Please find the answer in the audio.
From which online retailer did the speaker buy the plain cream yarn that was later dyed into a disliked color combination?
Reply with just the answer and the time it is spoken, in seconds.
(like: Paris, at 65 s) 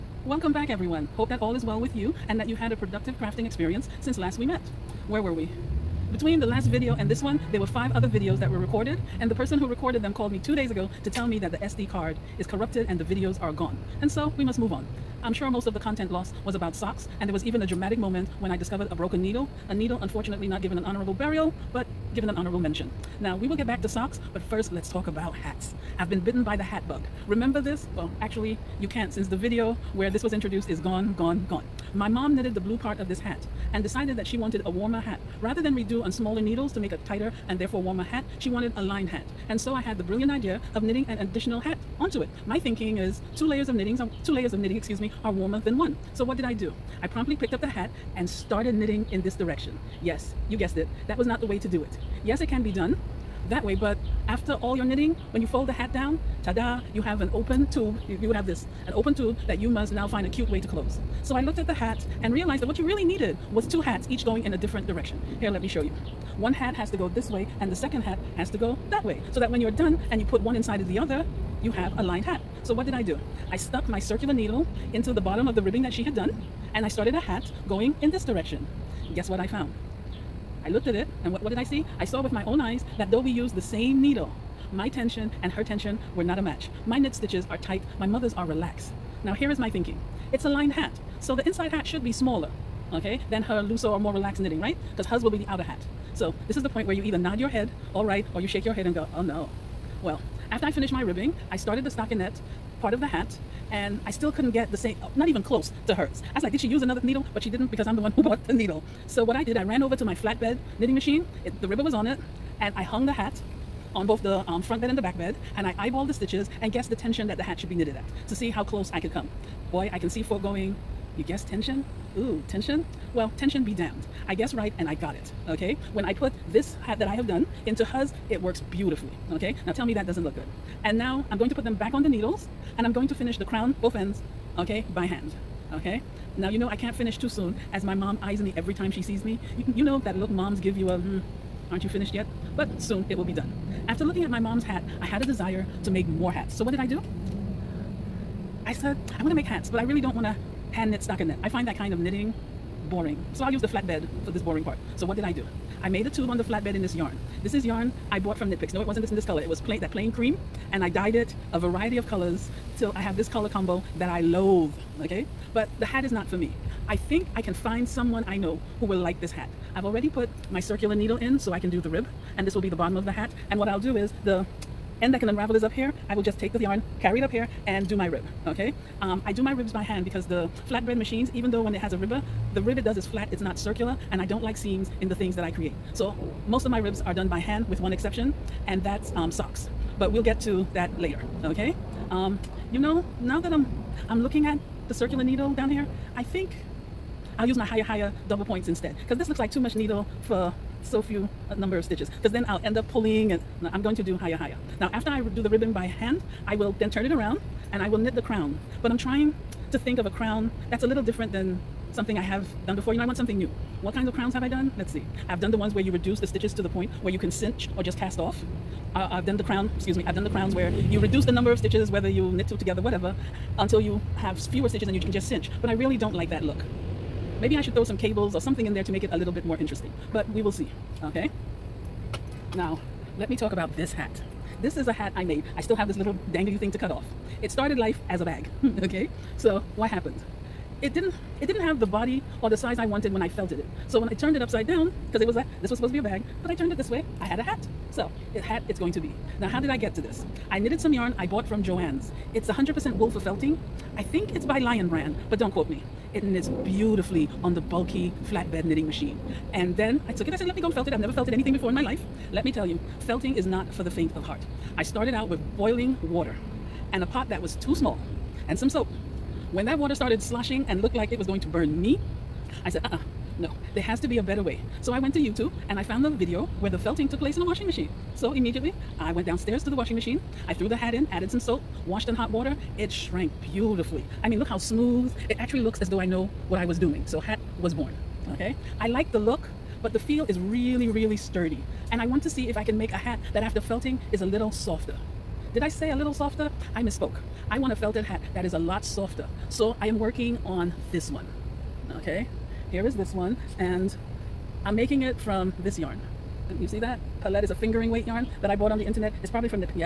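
Knit Picks, at 158 s.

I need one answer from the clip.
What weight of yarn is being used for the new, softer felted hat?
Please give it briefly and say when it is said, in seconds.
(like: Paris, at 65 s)
Fingering weight, at 307 s.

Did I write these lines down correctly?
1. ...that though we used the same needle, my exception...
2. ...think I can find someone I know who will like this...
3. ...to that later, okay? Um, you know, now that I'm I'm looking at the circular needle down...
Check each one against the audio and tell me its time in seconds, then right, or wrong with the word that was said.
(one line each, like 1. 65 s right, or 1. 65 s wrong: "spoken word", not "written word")
1. 82 s wrong: "tension", not "exception"
2. 166 s right
3. 190 s right.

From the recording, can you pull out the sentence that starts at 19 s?
A needle, unfortunately, not given an honorable burial, but given an honorable mention.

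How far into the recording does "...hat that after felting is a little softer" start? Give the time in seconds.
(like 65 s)
293 s.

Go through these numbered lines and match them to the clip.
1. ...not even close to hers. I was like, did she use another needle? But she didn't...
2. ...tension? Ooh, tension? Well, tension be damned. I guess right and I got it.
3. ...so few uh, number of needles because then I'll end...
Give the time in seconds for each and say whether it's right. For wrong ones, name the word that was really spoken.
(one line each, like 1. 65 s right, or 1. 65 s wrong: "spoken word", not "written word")
1. 105 s right
2. 121 s right
3. 200 s wrong: "stitches", not "needles".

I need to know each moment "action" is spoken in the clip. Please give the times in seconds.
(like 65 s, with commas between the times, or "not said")
not said.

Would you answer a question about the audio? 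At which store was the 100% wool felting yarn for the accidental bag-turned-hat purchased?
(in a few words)
Joann's.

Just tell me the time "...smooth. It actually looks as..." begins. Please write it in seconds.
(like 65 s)
284 s.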